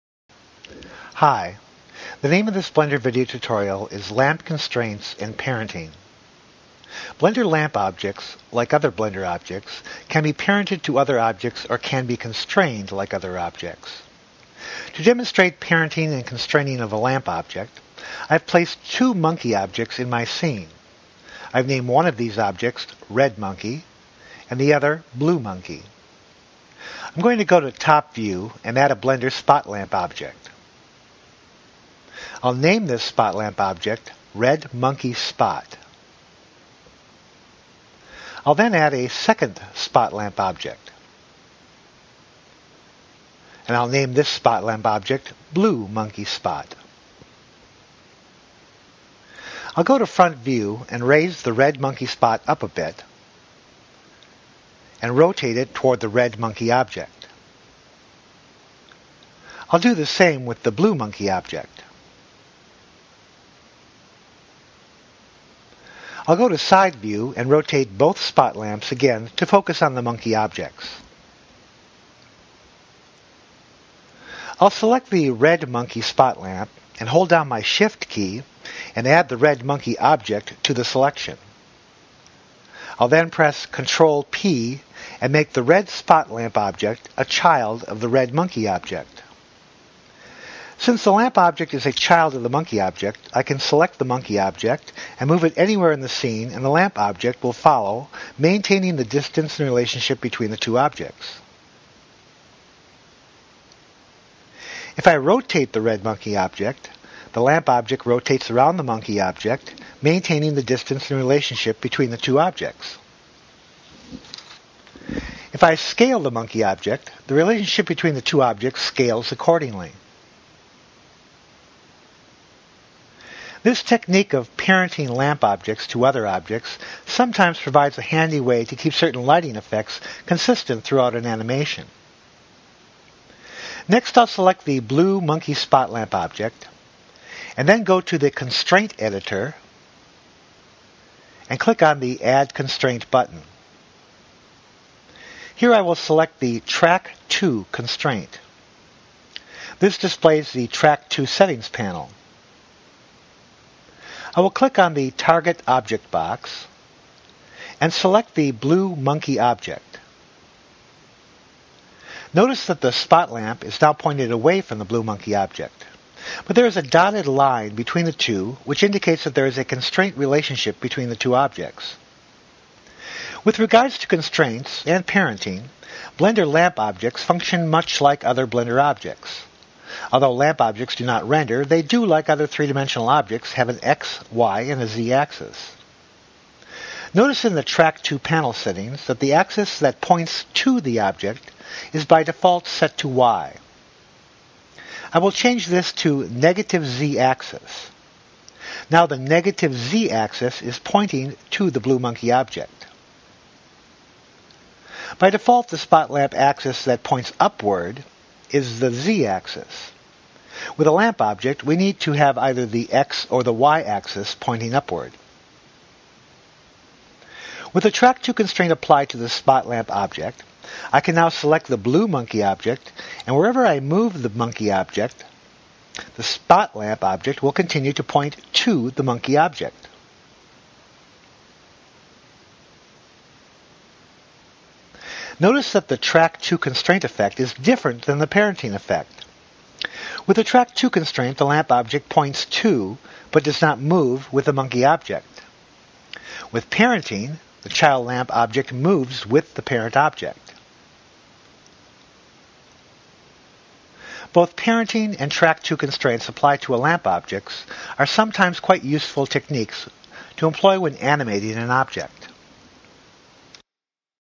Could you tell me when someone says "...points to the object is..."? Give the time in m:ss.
3:10.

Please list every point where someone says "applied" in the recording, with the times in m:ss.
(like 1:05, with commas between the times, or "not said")
3:38, 4:16.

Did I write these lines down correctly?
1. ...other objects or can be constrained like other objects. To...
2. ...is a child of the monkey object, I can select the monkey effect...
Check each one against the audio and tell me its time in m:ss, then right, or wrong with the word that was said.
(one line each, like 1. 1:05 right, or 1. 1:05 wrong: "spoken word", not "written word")
1. 0:10 right
2. 1:31 wrong: "object", not "effect".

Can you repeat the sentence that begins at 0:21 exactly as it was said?
I've named one of these objects Red Monkey and the other Blue Monkey.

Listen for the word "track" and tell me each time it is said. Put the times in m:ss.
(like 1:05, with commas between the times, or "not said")
2:26, 2:30, 3:07, 3:37, 3:55, 4:00, 4:15.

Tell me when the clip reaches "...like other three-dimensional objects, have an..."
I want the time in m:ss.
3:02.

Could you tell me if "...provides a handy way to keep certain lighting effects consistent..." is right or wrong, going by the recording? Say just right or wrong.
right.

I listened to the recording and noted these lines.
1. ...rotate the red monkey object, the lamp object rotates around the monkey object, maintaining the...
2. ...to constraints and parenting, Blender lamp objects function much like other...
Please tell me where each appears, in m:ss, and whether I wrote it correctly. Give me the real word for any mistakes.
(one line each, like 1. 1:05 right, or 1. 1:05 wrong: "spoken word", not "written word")
1. 1:45 right
2. 2:53 right.